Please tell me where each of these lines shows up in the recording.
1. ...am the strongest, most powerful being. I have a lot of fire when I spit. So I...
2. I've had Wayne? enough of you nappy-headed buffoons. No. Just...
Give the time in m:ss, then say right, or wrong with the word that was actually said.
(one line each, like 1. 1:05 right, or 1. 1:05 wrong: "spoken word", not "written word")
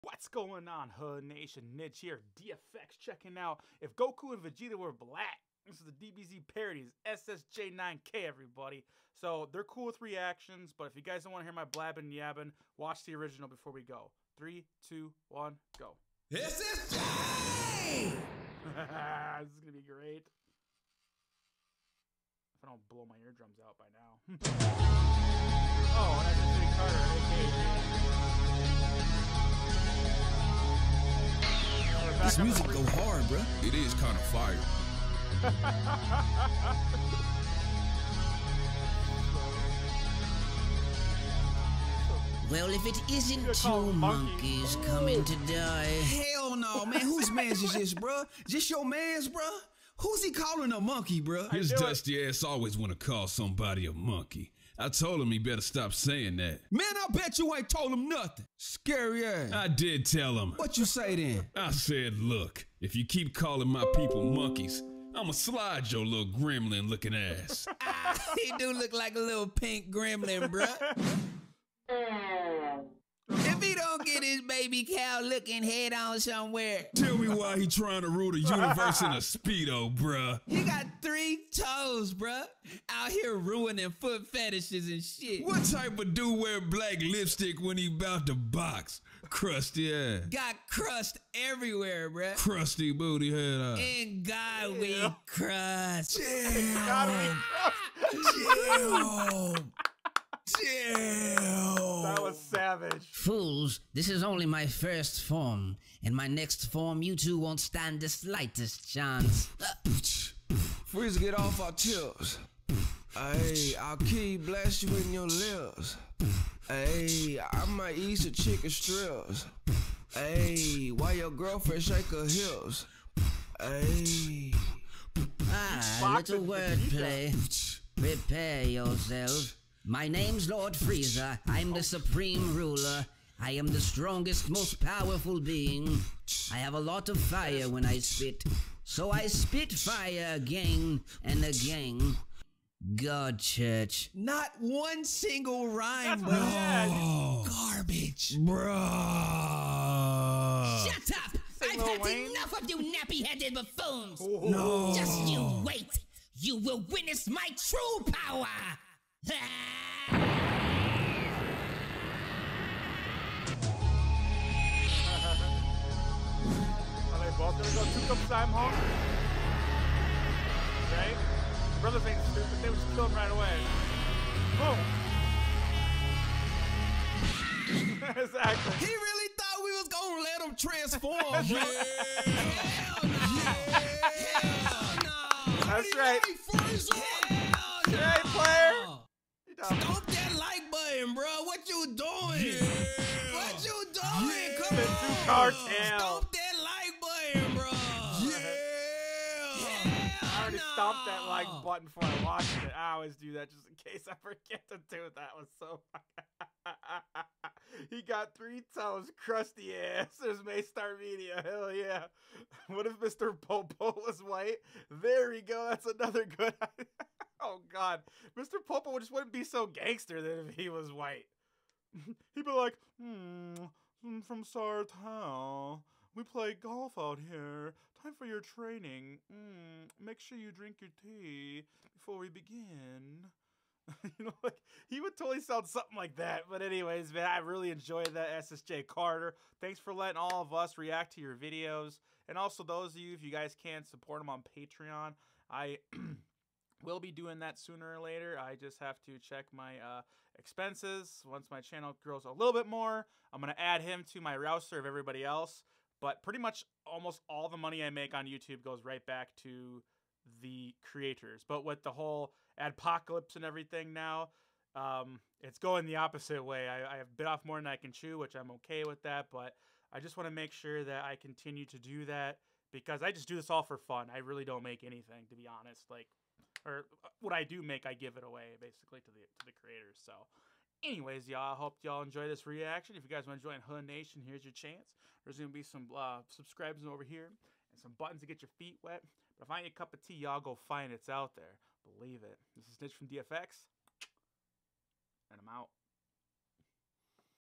1. 2:13 right
2. 2:31 right.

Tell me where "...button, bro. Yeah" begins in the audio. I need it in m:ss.
3:16.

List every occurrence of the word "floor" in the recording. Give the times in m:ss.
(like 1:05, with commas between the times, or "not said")
not said.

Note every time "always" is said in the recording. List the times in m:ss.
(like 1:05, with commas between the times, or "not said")
0:52, 3:22.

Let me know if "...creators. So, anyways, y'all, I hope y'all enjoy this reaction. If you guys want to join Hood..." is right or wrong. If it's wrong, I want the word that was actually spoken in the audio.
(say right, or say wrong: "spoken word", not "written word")
right.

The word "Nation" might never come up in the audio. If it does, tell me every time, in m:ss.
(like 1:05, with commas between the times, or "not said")
0:01, 4:43.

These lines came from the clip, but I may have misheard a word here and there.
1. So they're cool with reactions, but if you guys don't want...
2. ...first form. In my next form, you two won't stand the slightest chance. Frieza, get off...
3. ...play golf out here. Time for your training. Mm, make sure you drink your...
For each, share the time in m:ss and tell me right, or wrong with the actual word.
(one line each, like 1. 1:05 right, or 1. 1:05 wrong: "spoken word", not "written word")
1. 0:09 right
2. 1:44 right
3. 3:46 right.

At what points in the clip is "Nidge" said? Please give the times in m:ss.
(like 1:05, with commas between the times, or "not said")
0:01, 4:52.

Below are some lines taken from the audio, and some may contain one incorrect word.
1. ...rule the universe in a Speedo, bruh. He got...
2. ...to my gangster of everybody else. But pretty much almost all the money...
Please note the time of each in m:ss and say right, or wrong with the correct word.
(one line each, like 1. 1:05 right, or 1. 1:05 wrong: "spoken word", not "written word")
1. 1:18 right
2. 4:14 wrong: "roster", not "gangster".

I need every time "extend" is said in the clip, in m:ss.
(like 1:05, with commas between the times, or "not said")
not said.